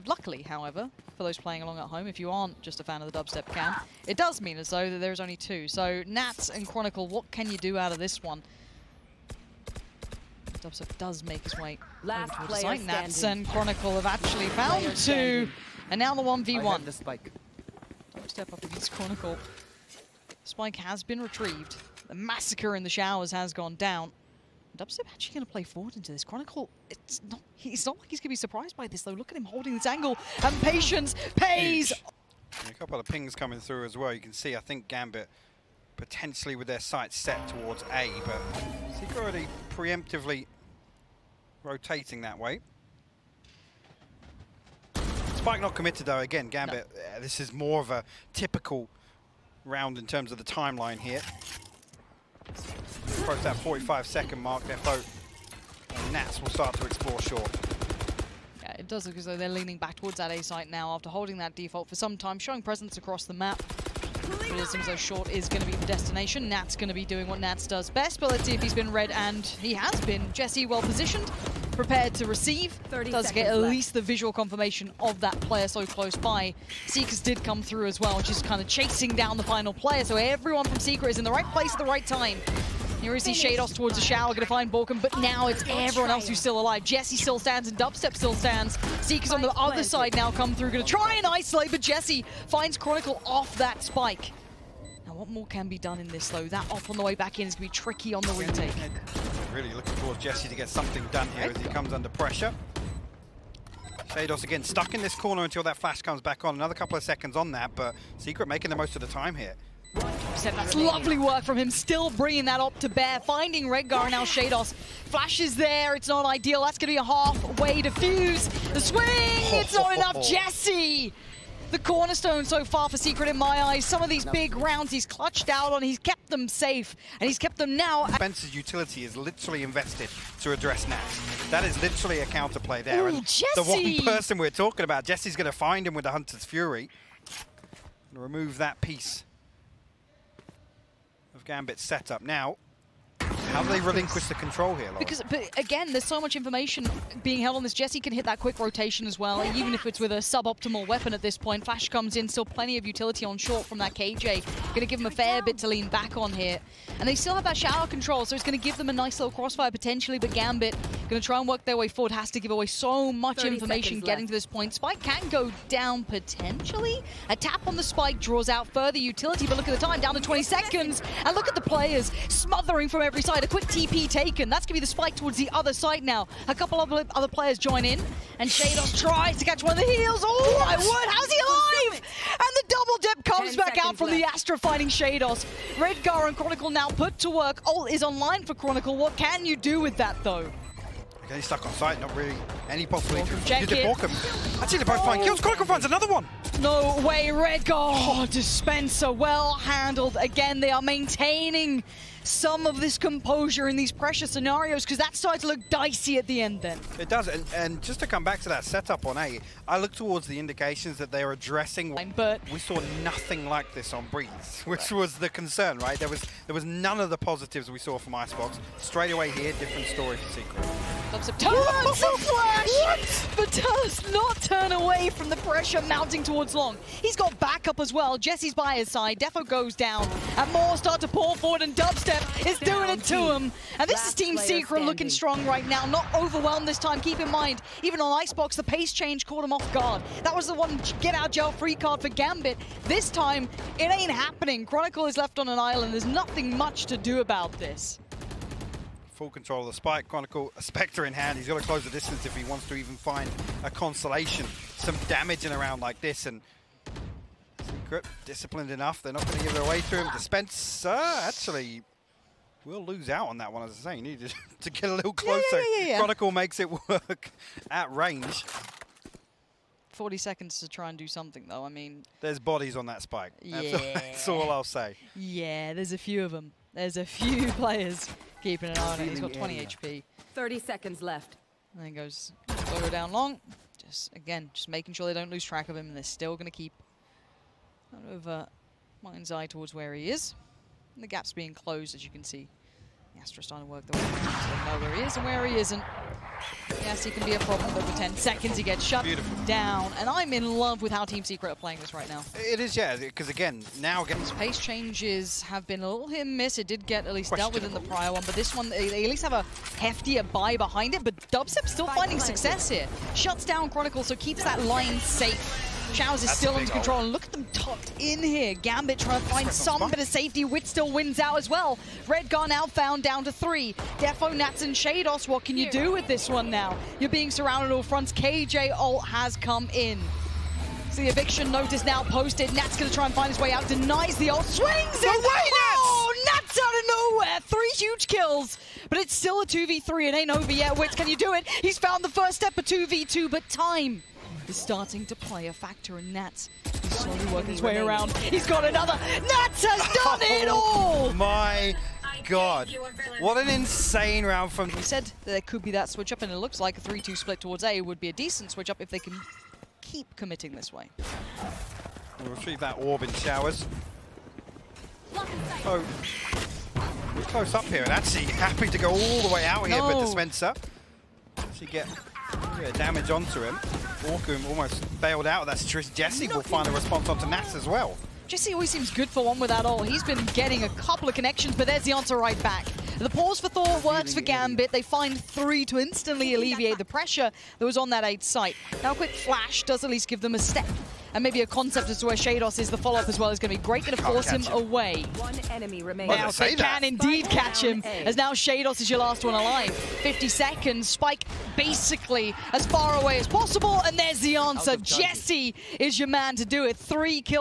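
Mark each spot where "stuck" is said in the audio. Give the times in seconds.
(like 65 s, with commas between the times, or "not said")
104 s, 191 s.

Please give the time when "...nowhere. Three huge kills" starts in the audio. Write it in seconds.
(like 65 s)
337 s.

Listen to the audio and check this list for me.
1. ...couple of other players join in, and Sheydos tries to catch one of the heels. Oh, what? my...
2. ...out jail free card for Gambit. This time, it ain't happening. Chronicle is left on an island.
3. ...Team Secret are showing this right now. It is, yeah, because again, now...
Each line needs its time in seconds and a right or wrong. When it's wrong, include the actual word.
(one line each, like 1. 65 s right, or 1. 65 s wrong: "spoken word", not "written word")
1. 176 s right
2. 241 s right
3. 301 s wrong: "playing", not "showing".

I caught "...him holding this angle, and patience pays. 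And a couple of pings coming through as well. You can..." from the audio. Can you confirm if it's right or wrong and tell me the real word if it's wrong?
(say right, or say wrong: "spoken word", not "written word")
right.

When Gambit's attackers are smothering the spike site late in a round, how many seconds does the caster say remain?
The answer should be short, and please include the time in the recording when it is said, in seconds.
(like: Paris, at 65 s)
20 seconds, at 170 s.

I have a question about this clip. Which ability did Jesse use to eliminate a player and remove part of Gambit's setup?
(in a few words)
Hunter's Fury.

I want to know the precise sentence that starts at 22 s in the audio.
The massacre in the showers has gone down.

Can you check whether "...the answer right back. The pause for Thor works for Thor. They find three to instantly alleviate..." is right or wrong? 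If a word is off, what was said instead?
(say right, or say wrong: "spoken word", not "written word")
wrong: "Gambit", not "Thor".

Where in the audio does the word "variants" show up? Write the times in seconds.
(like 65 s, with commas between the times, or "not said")
not said.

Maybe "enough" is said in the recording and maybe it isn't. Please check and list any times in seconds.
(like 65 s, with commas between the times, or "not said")
119 s, 258 s.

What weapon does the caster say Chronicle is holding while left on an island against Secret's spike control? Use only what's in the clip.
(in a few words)
Spectre.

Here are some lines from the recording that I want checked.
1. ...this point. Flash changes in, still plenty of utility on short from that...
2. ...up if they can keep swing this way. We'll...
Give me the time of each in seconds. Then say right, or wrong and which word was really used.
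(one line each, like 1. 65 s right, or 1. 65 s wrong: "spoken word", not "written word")
1. 151 s wrong: "comes", not "changes"
2. 358 s wrong: "committing", not "swing".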